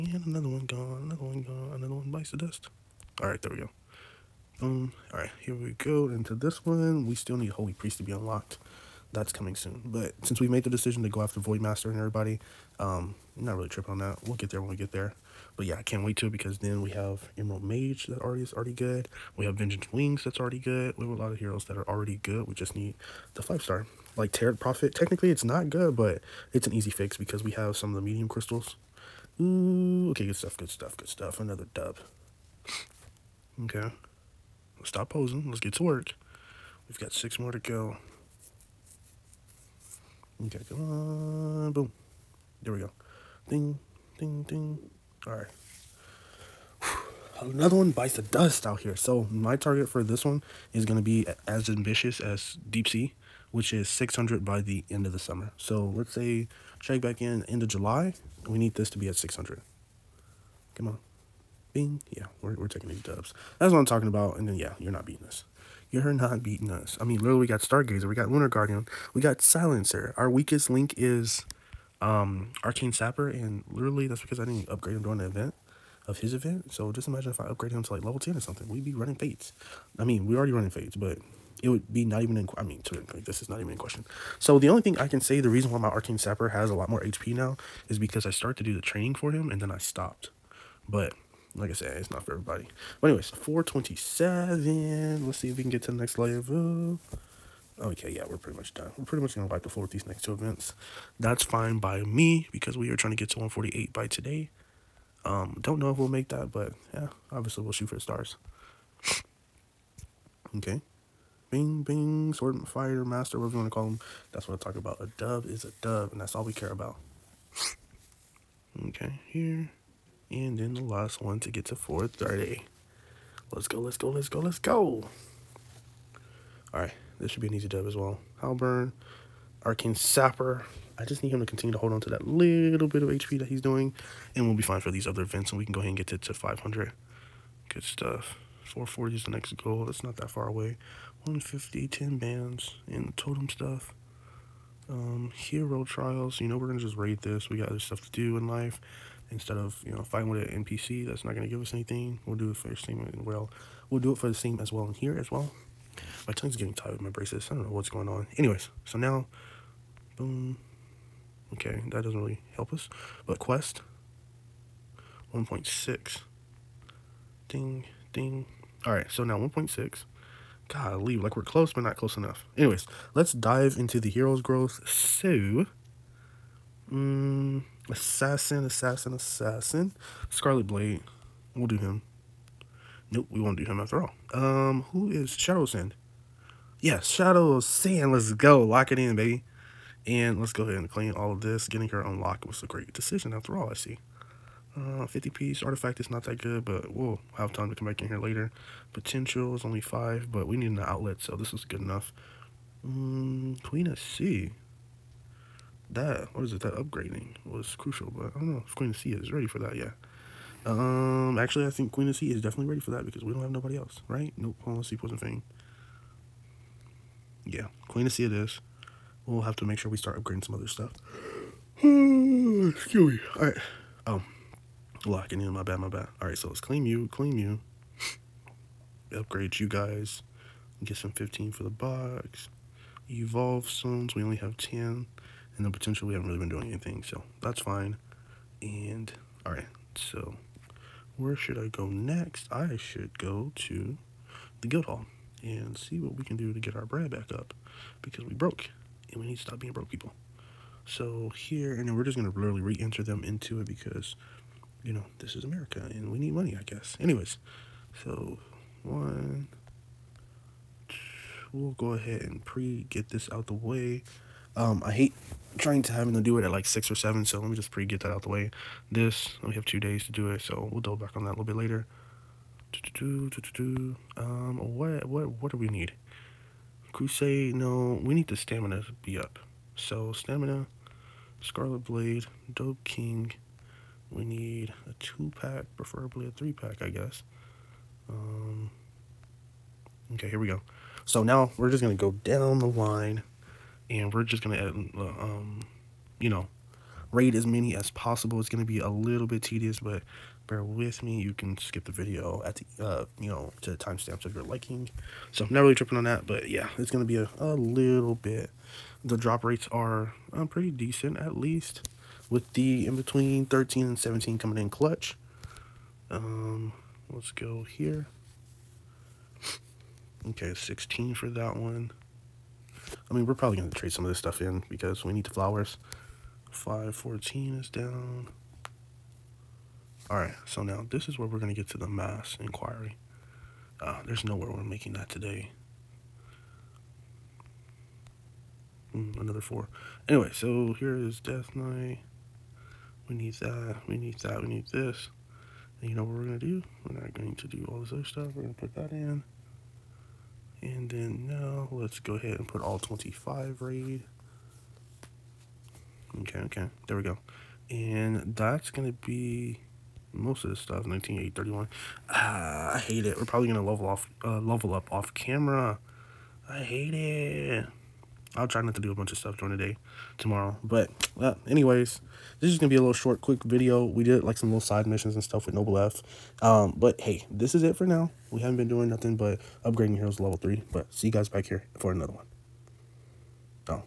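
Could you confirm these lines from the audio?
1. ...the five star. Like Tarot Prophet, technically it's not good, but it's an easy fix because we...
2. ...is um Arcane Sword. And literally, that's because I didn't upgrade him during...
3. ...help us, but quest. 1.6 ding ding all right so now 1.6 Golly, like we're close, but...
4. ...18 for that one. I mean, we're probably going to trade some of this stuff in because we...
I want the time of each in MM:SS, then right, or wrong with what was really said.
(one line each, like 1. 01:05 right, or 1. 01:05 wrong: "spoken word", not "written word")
1. 00:23 right
2. 01:10 wrong: "Sapper", not "Sword"
3. 02:42 right
4. 05:20 wrong: "16", not "18".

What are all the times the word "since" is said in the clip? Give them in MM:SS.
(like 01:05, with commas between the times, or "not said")
00:10.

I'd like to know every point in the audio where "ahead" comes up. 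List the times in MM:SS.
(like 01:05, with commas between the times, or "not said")
02:15, 03:10, 04:21, 05:52.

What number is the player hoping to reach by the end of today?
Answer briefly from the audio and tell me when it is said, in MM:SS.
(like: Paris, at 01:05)
148, at 01:43.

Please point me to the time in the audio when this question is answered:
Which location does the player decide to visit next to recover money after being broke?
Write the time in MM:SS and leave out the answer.
04:04.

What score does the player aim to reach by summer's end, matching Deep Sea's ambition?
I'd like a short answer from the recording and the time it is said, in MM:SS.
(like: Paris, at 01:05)
600, at 00:53.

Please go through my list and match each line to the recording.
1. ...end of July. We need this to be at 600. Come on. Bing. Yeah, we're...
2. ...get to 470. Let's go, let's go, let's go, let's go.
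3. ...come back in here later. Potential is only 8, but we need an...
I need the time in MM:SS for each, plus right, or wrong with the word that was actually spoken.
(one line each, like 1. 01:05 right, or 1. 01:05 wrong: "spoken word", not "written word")
1. 00:57 right
2. 02:01 wrong: "430", not "470"
3. 03:17 wrong: "5", not "8".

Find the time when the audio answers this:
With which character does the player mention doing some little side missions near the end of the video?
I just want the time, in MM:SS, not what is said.
06:15.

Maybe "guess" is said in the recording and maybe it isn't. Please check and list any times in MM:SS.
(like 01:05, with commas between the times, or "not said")
04:16, 04:46.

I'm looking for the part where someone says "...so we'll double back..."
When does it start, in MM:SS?
04:30.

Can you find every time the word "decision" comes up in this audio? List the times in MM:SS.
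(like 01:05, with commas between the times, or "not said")
00:10, 03:12.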